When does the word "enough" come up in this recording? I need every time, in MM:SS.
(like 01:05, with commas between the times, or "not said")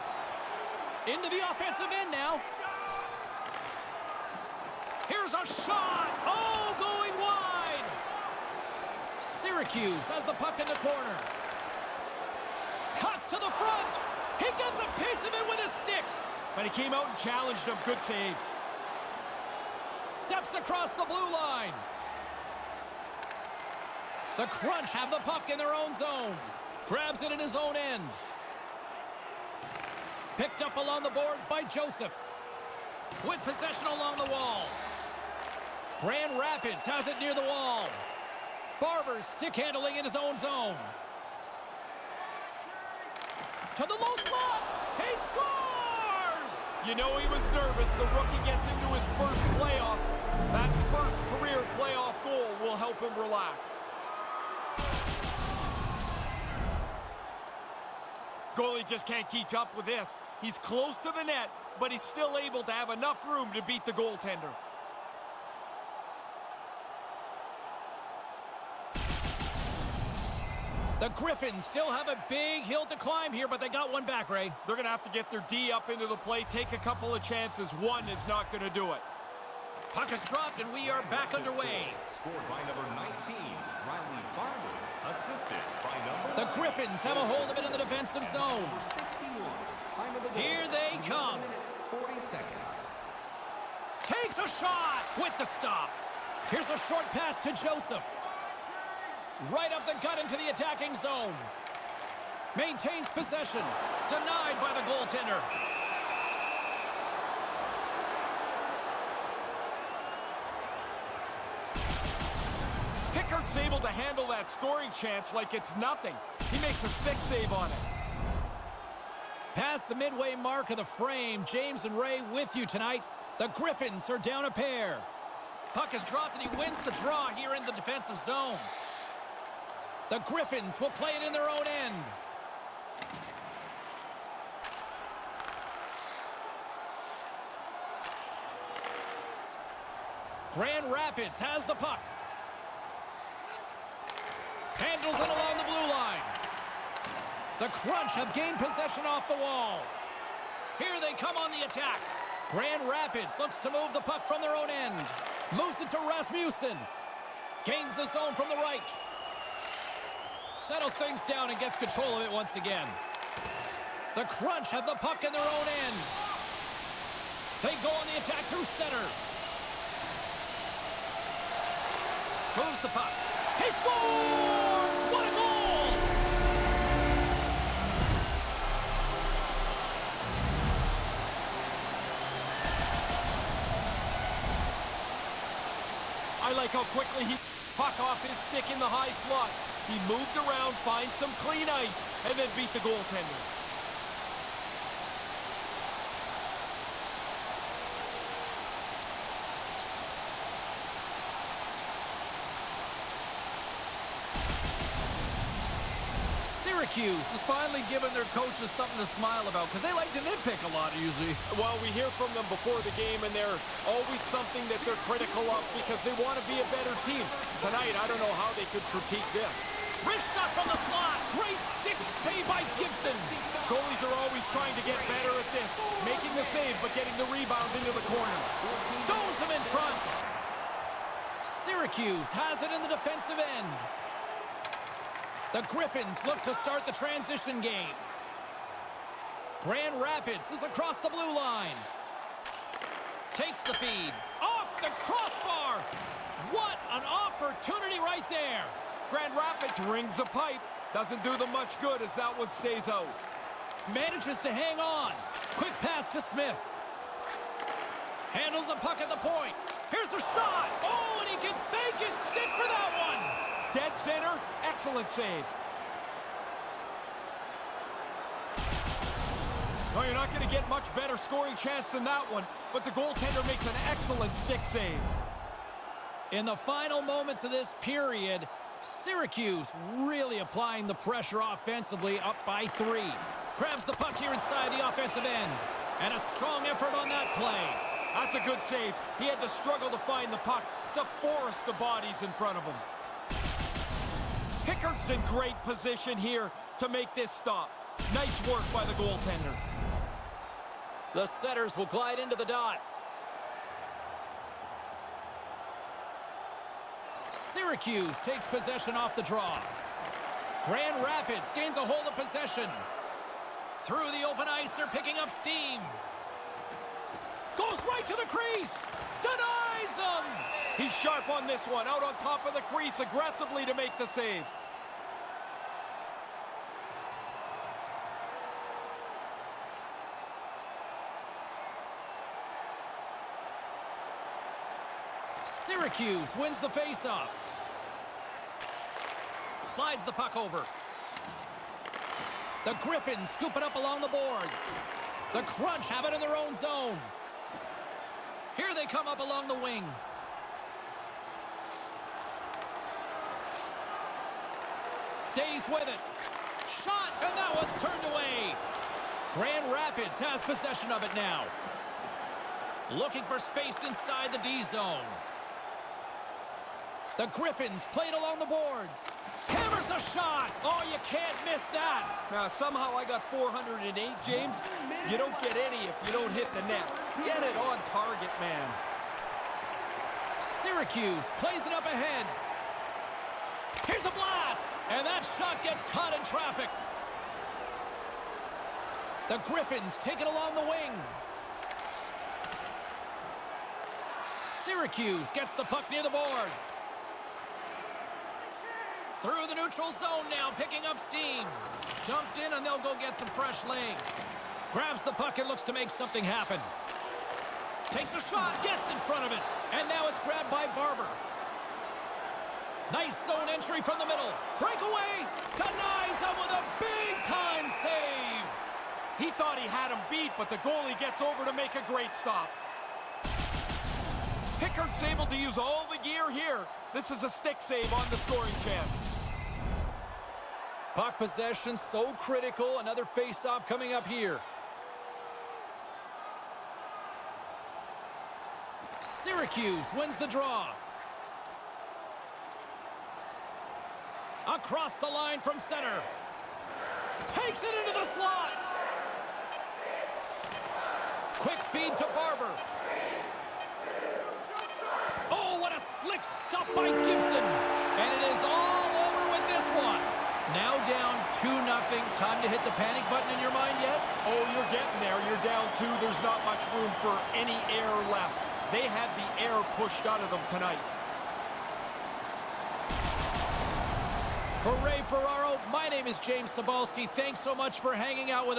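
01:02.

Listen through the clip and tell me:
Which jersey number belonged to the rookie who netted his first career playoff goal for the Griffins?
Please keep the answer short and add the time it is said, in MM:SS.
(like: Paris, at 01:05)
19, at 01:22.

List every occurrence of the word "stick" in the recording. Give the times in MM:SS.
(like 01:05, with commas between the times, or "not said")
00:15, 00:39, 01:56, 03:08, 03:41, 04:22, 04:34, 07:07.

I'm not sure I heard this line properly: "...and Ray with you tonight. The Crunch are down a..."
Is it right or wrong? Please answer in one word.
wrong.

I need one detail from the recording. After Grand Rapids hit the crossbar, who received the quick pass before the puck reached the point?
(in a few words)
Smith.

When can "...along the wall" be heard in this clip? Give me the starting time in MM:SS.
00:33.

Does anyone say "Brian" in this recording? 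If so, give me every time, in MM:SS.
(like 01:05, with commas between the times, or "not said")
not said.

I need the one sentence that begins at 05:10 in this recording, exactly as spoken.
Grand Rapids gains a hold of possession.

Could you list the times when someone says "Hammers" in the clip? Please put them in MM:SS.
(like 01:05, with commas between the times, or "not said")
06:09.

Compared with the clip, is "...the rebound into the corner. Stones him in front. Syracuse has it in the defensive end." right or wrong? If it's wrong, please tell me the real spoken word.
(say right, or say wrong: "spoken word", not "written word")
right.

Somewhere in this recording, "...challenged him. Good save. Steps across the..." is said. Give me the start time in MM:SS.
00:17.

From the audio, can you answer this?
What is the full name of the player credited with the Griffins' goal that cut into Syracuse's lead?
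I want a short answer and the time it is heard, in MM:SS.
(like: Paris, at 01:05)
Riley Farmer, at 01:23.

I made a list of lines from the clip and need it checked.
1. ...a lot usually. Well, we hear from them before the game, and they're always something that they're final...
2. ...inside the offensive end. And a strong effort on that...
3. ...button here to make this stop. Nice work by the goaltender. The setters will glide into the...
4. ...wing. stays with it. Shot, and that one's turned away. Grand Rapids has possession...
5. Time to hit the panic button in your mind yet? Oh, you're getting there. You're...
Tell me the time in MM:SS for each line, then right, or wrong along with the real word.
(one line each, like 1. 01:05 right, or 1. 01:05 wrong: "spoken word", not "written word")
1. 03:30 wrong: "critical", not "final"
2. 04:44 right
3. 04:55 wrong: "position", not "button"
4. 05:49 right
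5. 07:42 right.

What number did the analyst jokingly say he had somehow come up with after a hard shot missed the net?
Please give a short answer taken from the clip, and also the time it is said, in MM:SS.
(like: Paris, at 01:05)
408, at 06:13.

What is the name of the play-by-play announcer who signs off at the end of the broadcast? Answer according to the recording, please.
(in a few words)
James Cybulski.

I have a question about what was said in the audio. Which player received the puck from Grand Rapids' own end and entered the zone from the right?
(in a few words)
Rasmussen.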